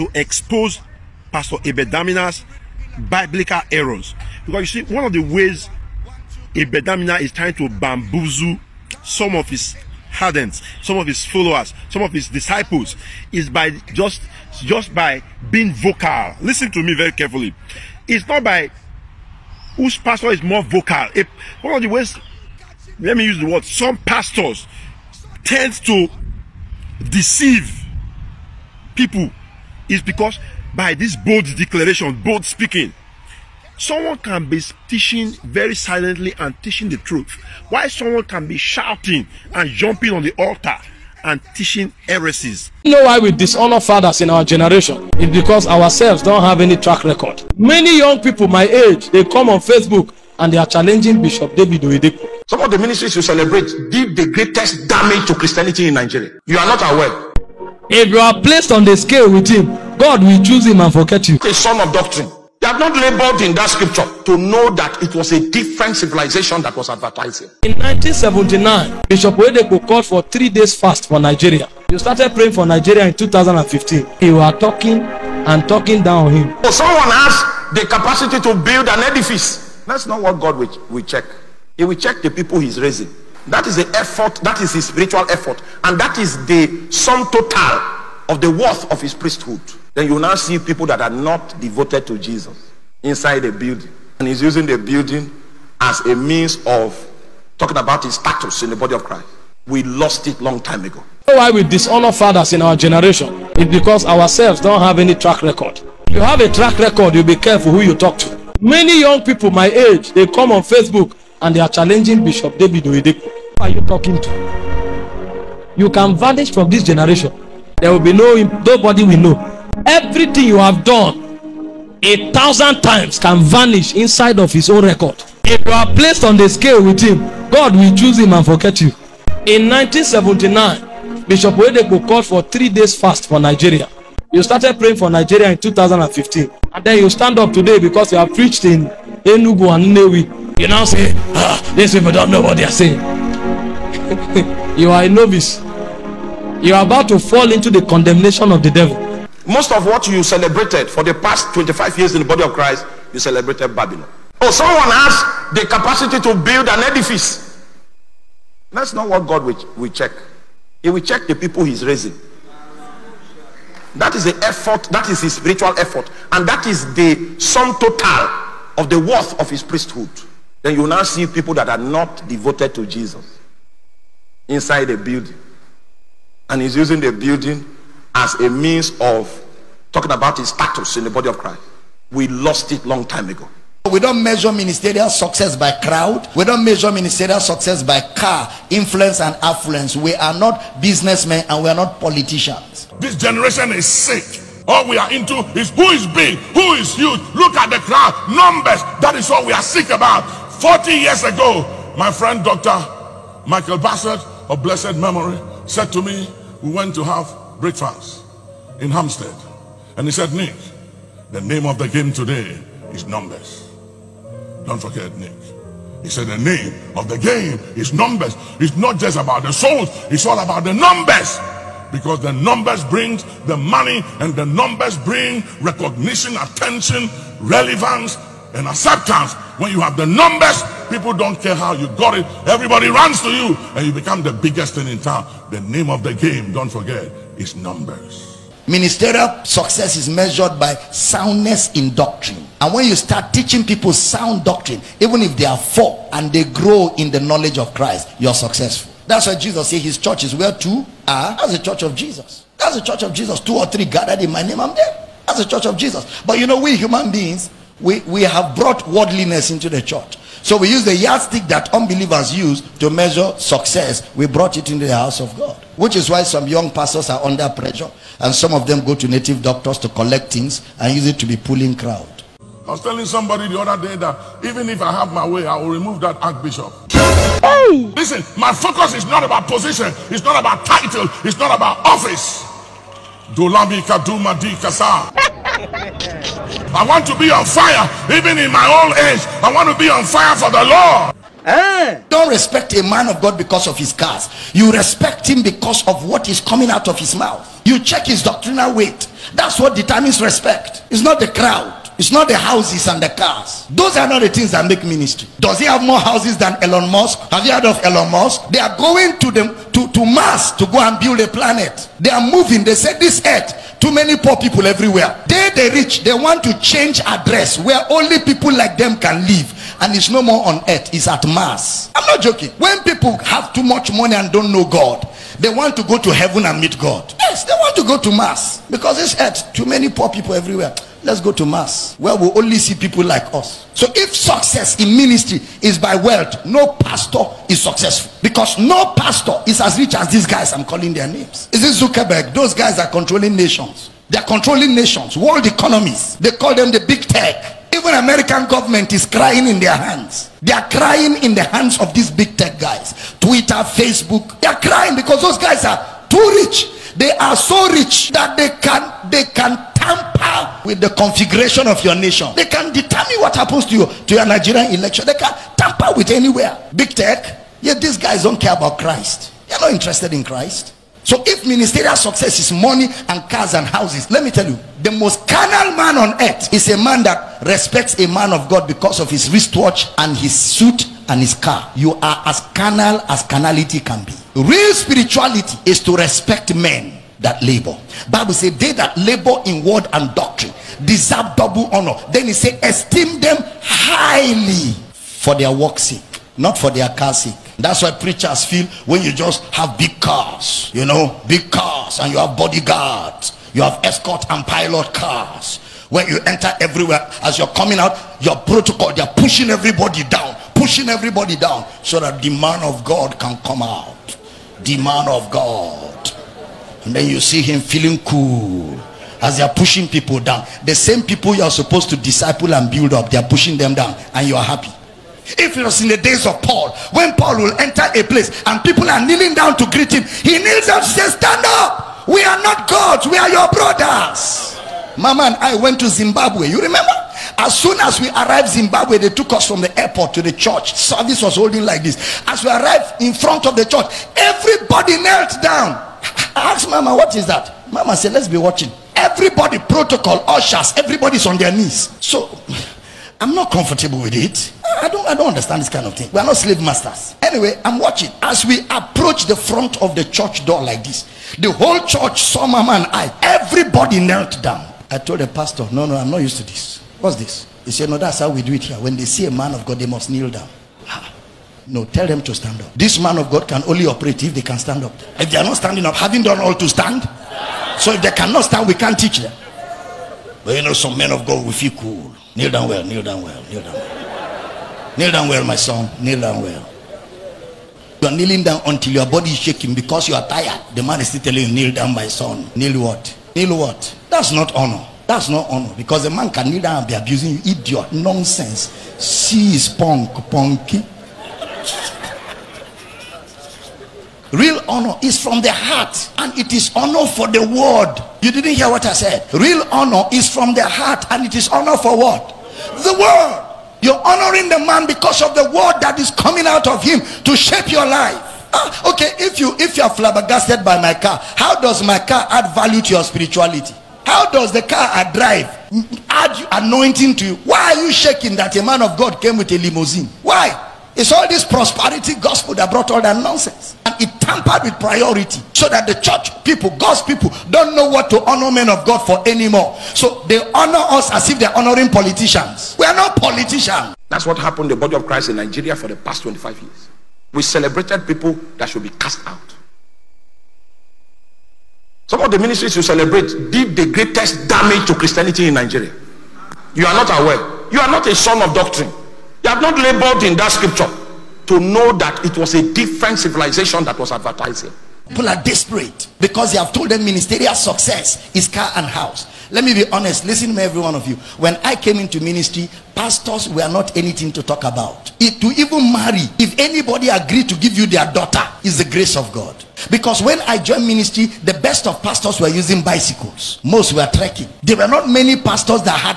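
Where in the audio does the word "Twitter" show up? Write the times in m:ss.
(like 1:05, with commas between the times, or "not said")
5:53.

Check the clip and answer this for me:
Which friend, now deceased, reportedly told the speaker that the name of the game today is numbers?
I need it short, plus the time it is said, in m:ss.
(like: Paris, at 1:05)
Dr. Michael Bassett, at 3:22.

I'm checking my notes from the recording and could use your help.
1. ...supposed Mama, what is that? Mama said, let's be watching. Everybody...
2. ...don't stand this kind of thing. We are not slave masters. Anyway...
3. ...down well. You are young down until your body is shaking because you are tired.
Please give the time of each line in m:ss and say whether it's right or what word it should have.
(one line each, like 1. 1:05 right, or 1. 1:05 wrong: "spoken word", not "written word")
1. 7:26 wrong: "asked", not "supposed"
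2. 7:35 wrong: "understand", not "stand"
3. 8:06 wrong: "kneeling", not "young".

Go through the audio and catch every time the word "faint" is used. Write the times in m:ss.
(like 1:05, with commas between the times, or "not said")
not said.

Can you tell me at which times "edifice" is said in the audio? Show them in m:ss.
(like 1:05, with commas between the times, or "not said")
1:19, 2:36.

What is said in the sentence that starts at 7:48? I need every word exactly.
When they see a man of God, they must kneel down.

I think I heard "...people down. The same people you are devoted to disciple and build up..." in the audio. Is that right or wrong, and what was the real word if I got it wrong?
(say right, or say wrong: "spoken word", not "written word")
wrong: "supposed", not "devoted".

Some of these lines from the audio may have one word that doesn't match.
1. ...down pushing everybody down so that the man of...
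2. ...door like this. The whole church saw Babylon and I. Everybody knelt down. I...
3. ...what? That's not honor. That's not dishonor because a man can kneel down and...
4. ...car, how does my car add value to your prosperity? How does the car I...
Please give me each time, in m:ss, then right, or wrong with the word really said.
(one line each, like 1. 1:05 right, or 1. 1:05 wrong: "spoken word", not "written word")
1. 6:50 right
2. 7:40 wrong: "Mama", not "Babylon"
3. 8:13 wrong: "honor", not "dishonor"
4. 8:40 wrong: "spirituality", not "prosperity".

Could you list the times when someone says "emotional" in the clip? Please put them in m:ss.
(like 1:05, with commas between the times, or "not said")
not said.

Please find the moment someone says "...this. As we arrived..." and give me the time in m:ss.
7:21.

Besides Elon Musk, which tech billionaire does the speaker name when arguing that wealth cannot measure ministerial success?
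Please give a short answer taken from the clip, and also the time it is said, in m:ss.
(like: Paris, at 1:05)
Zuckerberg, at 5:41.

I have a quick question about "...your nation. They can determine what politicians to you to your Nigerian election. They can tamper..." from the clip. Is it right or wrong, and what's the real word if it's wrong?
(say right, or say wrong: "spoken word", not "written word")
wrong: "happens", not "politicians".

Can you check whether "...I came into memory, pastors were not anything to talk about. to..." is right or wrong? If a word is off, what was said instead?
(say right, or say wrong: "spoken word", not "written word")
wrong: "ministry", not "memory".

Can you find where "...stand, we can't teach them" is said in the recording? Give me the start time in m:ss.
7:58.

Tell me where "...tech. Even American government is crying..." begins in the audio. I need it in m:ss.
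5:47.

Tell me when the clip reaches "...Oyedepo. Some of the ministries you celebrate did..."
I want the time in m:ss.
0:51.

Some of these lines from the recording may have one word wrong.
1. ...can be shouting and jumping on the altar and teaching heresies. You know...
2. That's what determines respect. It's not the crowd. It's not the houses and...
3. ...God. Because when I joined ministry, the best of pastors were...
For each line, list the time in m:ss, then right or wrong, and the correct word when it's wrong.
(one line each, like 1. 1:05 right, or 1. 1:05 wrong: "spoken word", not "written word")
1. 0:38 right
2. 4:59 right
3. 9:39 right.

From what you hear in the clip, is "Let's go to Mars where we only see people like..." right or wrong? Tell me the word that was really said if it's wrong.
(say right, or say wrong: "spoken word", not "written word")
right.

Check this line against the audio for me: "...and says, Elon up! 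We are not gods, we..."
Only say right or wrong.
wrong.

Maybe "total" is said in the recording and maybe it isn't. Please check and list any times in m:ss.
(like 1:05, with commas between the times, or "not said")
1:27, 2:47.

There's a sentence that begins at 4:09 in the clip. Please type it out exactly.
That's why Jesus said his church is where two are.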